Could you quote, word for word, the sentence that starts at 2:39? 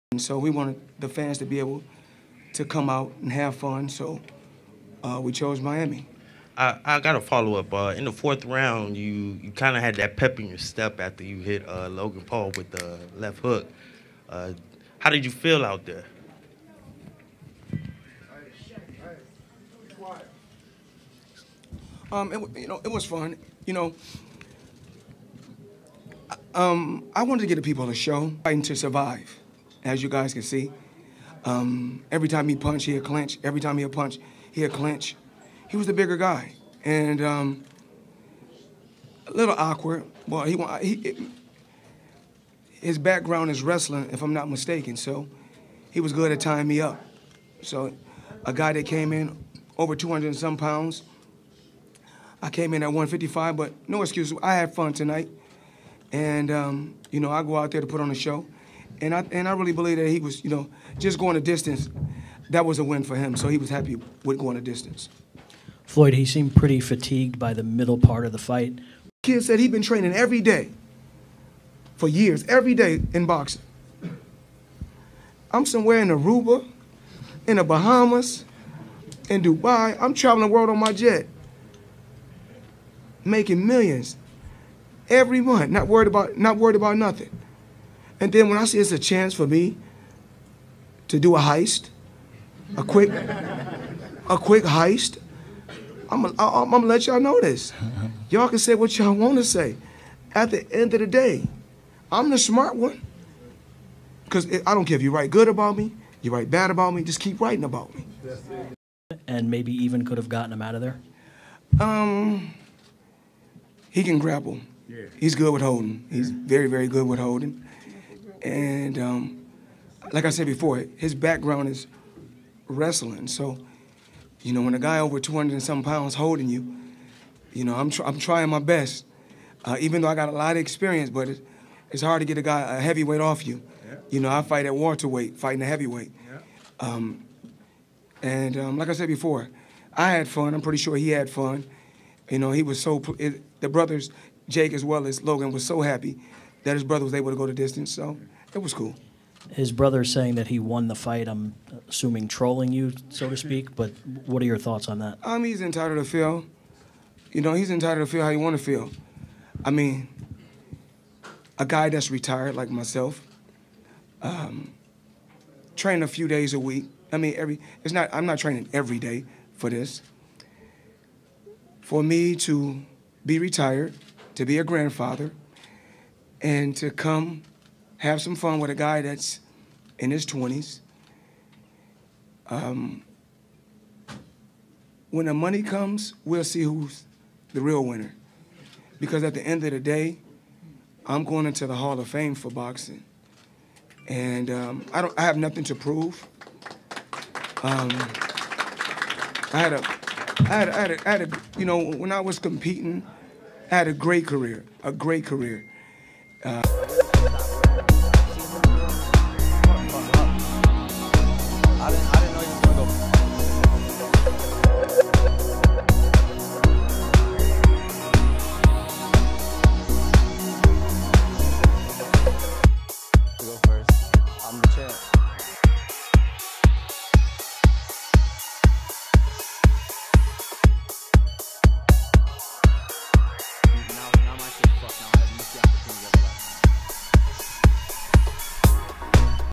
I mean, a guy that's retired like myself, um, train a few days a week.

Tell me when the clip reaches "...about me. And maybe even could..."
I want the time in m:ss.
1:47.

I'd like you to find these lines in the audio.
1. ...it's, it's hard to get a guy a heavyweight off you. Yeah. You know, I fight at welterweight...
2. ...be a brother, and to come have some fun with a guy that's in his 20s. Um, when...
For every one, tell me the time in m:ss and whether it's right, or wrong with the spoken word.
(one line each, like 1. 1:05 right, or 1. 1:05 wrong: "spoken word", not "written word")
1. 2:11 right
2. 2:54 wrong: "grandfather", not "brother".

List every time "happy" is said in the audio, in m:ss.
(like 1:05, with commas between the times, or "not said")
1:03, 2:25.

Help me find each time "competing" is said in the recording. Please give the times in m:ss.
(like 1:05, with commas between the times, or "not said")
3:22.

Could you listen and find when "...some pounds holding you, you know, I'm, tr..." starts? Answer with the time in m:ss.
2:05.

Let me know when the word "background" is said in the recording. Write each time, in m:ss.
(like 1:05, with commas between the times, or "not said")
0:42, 2:01.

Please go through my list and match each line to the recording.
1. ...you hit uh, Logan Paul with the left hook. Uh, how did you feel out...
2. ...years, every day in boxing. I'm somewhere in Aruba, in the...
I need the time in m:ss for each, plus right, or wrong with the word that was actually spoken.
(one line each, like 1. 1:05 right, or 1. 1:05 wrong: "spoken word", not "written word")
1. 0:11 right
2. 1:12 right.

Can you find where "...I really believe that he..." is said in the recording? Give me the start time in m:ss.
0:59.